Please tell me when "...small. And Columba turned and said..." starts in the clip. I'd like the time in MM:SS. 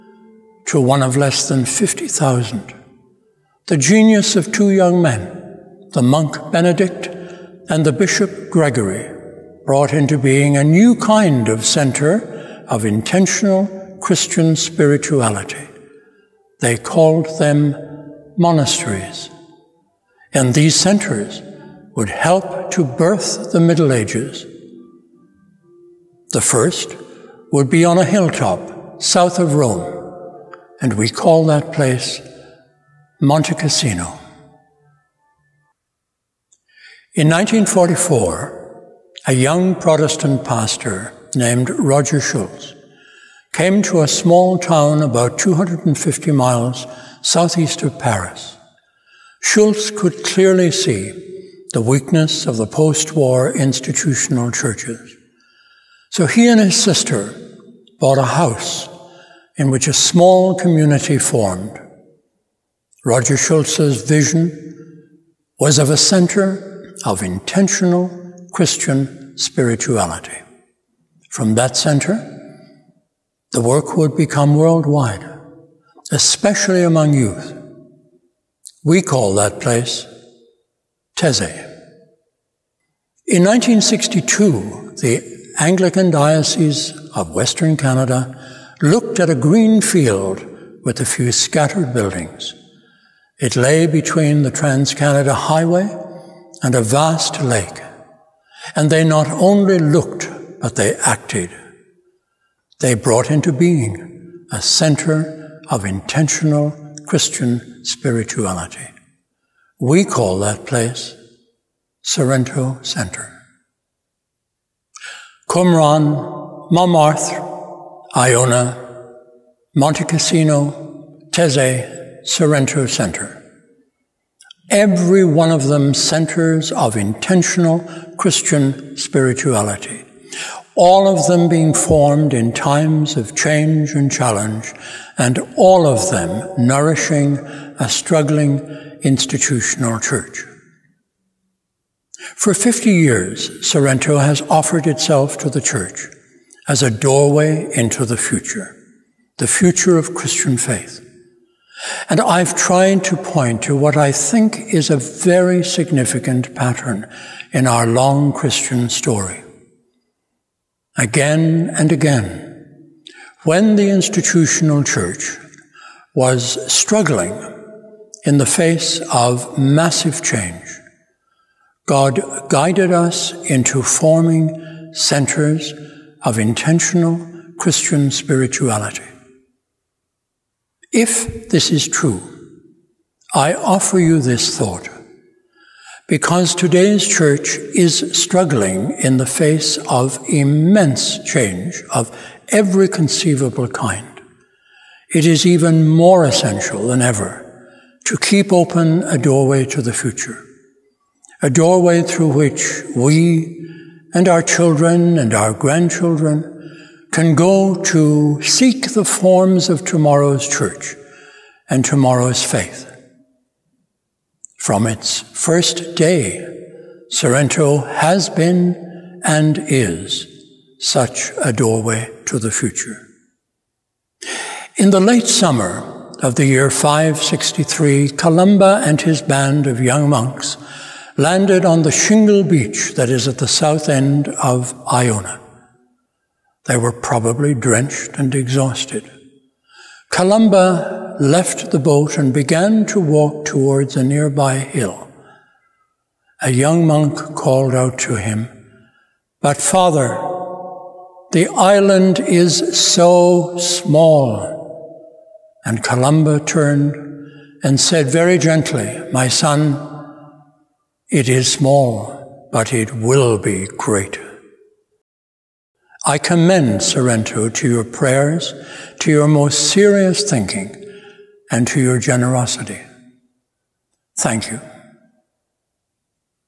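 04:13.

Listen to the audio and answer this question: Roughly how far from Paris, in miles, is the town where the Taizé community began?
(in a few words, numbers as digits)
250 miles.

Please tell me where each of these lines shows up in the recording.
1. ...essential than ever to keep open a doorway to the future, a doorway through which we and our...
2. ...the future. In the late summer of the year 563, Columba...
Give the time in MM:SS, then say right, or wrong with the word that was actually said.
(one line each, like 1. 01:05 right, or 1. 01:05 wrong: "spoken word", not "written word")
1. 03:16 right
2. 03:42 right.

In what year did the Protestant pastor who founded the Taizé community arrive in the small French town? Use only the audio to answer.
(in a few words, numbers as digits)
1944.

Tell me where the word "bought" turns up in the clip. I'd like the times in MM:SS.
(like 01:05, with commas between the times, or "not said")
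00:57.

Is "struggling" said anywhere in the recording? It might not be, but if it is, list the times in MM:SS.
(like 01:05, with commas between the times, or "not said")
02:17, 02:46, 03:08.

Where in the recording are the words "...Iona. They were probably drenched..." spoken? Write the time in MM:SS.
03:54.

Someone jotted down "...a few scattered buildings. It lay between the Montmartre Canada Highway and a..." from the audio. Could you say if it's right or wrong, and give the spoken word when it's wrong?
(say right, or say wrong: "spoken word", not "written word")
wrong: "Trans", not "Montmartre".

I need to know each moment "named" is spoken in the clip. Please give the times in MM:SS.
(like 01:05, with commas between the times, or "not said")
00:41.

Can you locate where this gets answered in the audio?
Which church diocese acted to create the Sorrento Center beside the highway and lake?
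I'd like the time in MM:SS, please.
01:25.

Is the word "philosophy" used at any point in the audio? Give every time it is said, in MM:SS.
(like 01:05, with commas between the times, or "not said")
not said.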